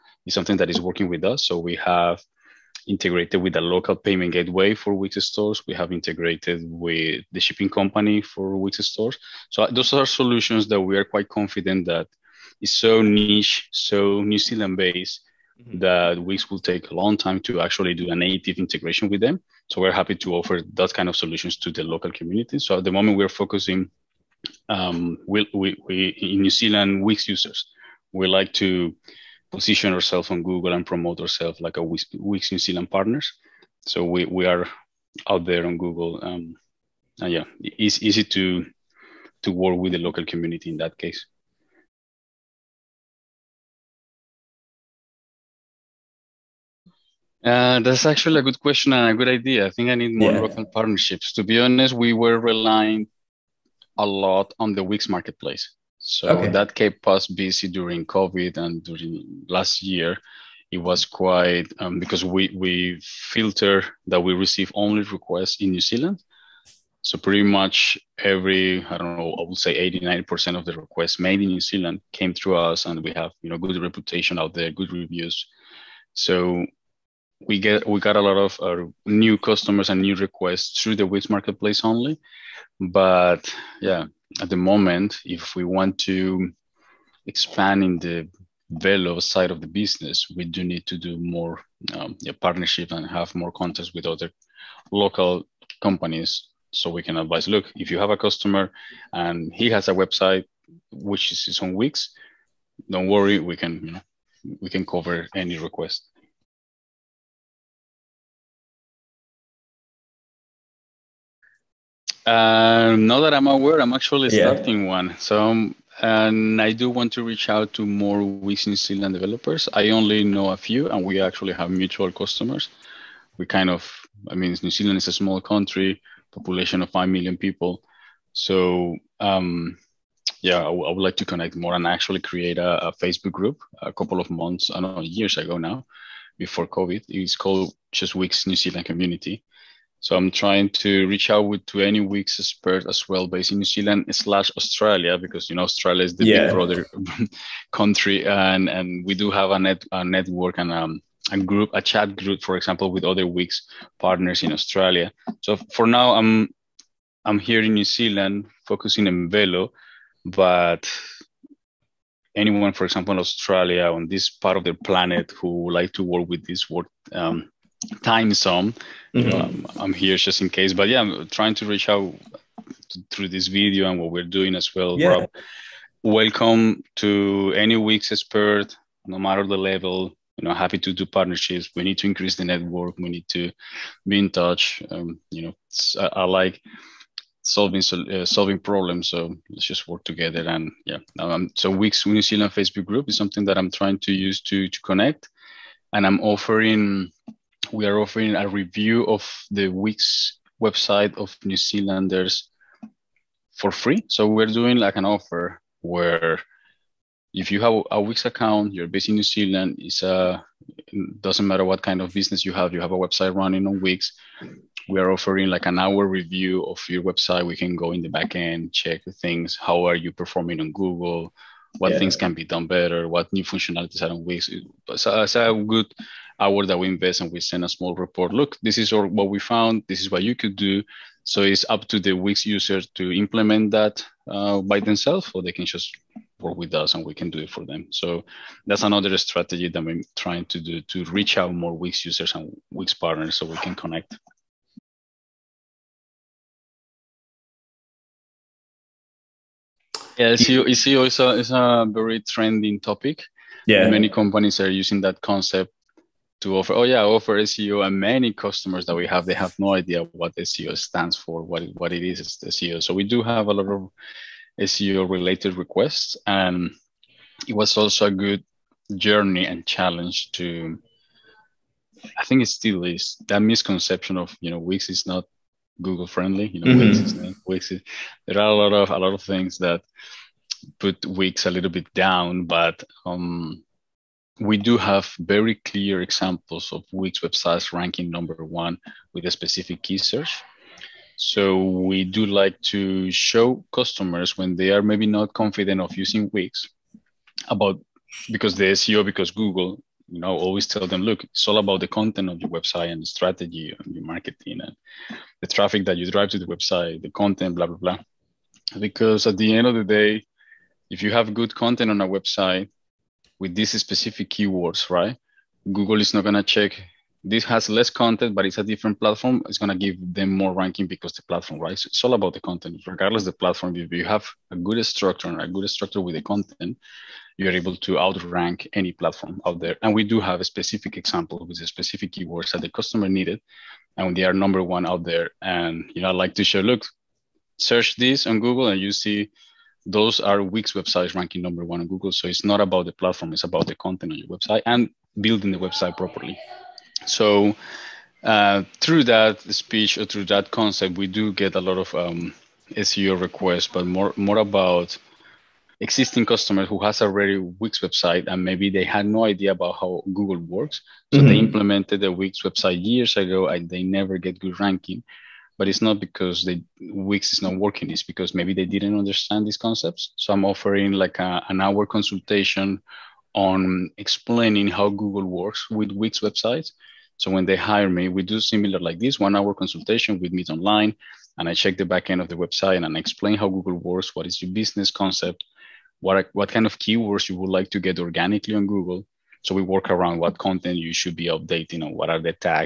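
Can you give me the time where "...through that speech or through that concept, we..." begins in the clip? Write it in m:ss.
5:48.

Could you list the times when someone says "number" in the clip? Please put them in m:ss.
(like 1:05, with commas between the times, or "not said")
4:48, 5:34, 5:41.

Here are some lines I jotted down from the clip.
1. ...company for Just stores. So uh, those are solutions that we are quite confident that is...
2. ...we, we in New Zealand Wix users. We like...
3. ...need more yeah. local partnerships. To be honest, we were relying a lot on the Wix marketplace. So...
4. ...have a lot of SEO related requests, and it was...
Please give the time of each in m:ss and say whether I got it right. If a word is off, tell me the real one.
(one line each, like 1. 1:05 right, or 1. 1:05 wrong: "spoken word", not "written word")
1. 0:07 wrong: "Wix", not "Just"
2. 0:25 right
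3. 0:49 right
4. 4:23 right.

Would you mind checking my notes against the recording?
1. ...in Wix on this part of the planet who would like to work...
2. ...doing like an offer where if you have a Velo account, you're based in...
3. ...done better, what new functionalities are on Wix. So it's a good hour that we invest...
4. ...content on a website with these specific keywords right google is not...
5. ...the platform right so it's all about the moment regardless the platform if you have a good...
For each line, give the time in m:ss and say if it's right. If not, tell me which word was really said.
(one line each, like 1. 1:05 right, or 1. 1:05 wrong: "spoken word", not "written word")
1. 2:43 wrong: "Australia", not "Wix"
2. 3:24 wrong: "Wix", not "Velo"
3. 3:42 right
4. 5:11 right
5. 5:21 wrong: "content", not "moment".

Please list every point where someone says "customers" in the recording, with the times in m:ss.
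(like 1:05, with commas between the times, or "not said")
1:19, 1:38, 2:02, 4:18, 4:53, 5:32, 5:56.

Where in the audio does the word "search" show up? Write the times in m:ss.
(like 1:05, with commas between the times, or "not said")
4:49, 5:37.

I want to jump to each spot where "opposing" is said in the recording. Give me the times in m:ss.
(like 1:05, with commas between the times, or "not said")
not said.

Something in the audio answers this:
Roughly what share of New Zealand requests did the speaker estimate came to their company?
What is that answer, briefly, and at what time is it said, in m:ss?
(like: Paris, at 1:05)
80-90%, at 1:09.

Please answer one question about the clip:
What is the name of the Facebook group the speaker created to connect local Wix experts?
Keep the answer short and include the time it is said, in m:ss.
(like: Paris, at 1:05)
Just Wix New Zealand Community, at 2:17.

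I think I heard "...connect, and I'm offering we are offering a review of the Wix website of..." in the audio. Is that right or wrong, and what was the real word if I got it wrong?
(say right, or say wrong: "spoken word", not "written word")
right.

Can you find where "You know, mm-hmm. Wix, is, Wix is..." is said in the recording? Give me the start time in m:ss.
4:36.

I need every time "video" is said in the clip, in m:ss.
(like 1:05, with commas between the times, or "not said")
2:53.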